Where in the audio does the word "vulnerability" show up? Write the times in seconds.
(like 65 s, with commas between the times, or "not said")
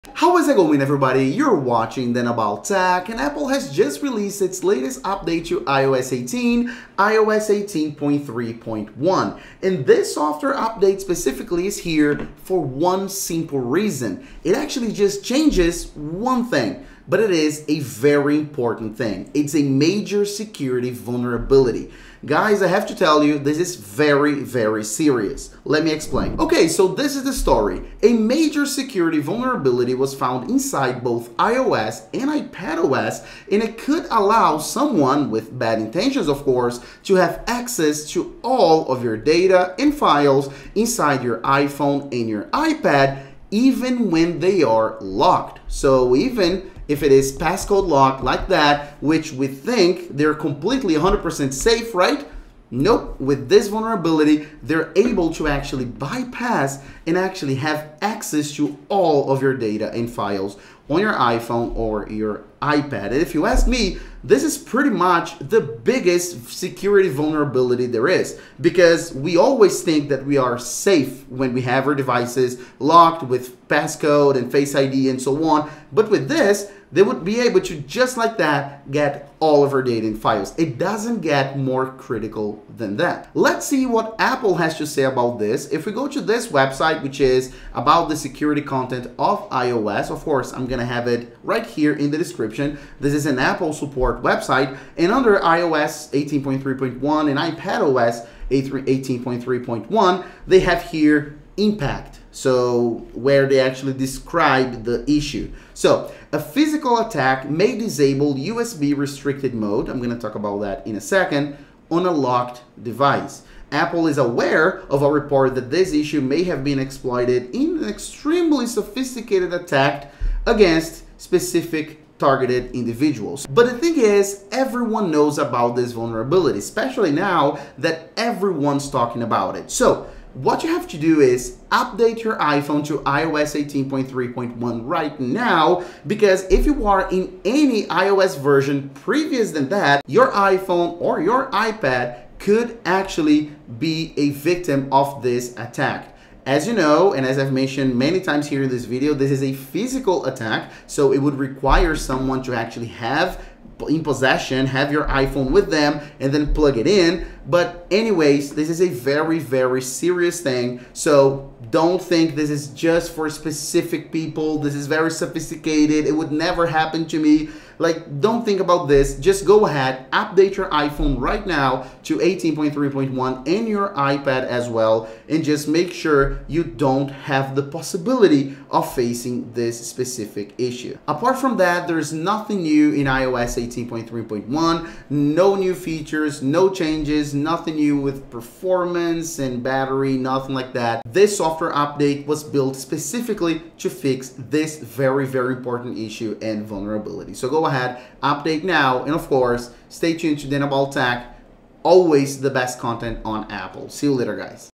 20 s, 29 s, 53 s, 67 s, 125 s, 196 s.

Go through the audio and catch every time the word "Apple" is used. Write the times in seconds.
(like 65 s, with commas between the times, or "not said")
3 s, 84 s, 93 s, 113 s, 203 s.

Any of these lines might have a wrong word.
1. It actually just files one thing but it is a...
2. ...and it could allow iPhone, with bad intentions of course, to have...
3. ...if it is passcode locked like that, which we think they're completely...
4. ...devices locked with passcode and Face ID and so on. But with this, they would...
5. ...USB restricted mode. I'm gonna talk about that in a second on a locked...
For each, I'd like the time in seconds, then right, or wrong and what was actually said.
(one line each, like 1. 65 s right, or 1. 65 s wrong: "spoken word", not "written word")
1. 14 s wrong: "changes", not "files"
2. 33 s wrong: "someone", not "iPhone"
3. 46 s right
4. 71 s right
5. 108 s right.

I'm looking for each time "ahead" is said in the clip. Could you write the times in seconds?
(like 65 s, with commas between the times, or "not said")
169 s, 197 s.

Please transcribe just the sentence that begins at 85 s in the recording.
If we go to this website, which is about about the security content of iOS.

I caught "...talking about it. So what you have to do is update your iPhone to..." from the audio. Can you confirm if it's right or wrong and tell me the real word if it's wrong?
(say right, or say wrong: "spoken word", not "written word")
right.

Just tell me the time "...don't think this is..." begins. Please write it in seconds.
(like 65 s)
161 s.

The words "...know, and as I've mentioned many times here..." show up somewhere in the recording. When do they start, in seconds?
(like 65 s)
146 s.